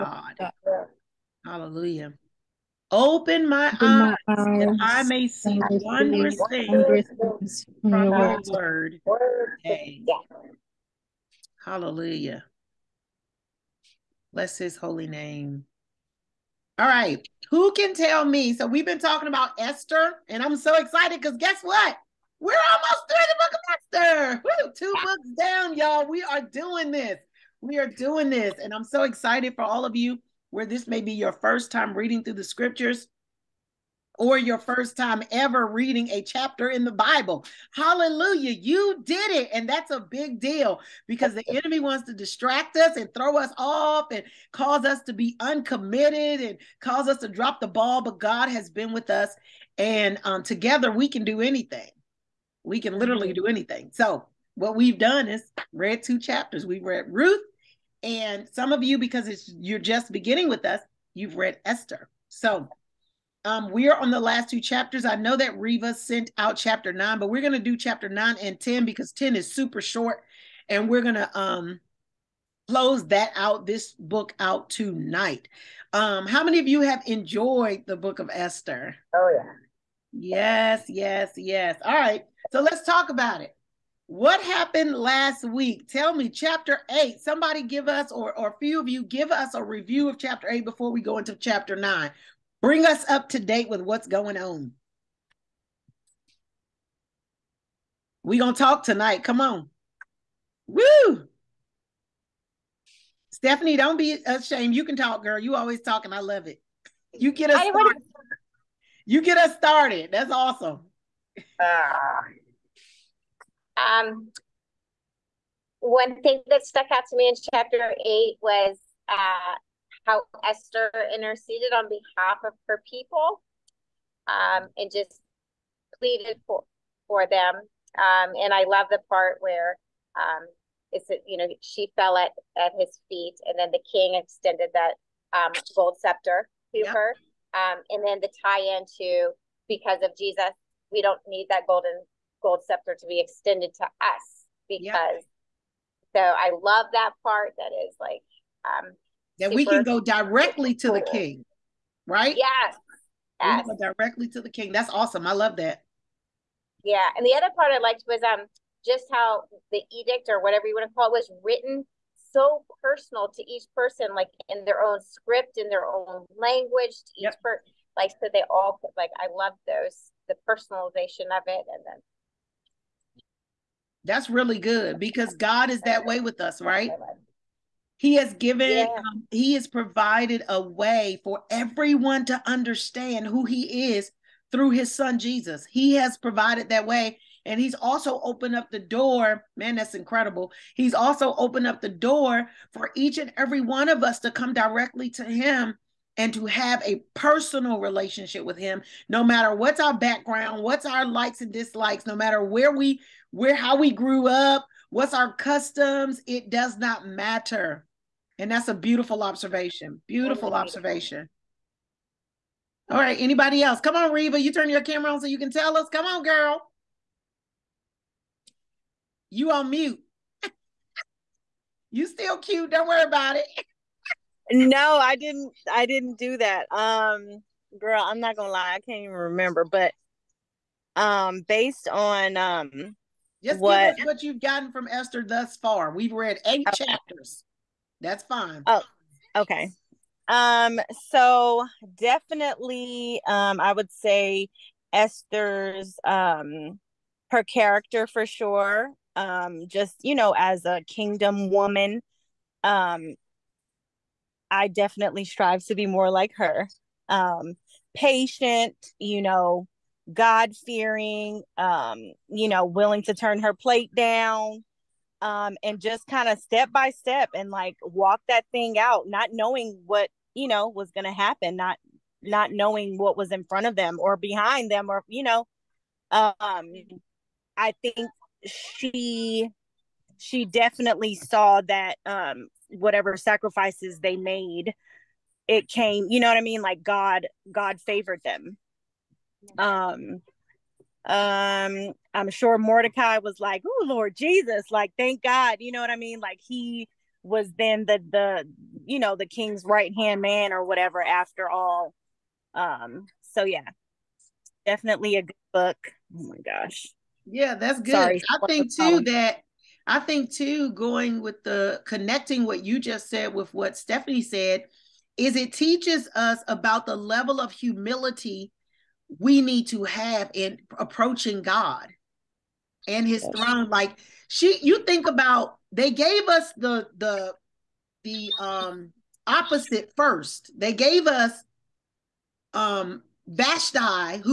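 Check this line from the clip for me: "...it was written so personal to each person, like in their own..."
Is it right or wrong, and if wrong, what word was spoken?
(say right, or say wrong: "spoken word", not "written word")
right.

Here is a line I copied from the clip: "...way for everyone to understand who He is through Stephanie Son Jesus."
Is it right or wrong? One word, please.
wrong.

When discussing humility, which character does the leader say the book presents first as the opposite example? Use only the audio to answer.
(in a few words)
Vashti.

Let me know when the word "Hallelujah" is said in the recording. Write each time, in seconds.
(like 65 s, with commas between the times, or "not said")
1 s, 11 s, 37 s.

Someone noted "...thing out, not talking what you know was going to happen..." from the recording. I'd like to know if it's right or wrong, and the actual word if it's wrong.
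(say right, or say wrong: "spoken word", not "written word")
wrong: "knowing", not "talking".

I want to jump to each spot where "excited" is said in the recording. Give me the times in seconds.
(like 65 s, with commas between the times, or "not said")
20 s, 29 s.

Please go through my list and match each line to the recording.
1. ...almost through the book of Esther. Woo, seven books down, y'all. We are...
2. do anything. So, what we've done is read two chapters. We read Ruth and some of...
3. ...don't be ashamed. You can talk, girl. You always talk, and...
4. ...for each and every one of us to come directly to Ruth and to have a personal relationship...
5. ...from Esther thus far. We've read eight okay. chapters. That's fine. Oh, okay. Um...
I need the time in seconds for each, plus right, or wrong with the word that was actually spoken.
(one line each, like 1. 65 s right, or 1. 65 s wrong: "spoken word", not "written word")
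1. 22 s wrong: "two", not "seven"
2. 53 s right
3. 103 s right
4. 192 s wrong: "Him", not "Ruth"
5. 234 s right.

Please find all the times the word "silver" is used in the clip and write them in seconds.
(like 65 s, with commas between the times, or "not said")
not said.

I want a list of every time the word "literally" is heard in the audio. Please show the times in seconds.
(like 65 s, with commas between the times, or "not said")
52 s.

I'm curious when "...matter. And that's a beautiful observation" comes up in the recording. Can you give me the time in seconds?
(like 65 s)
207 s.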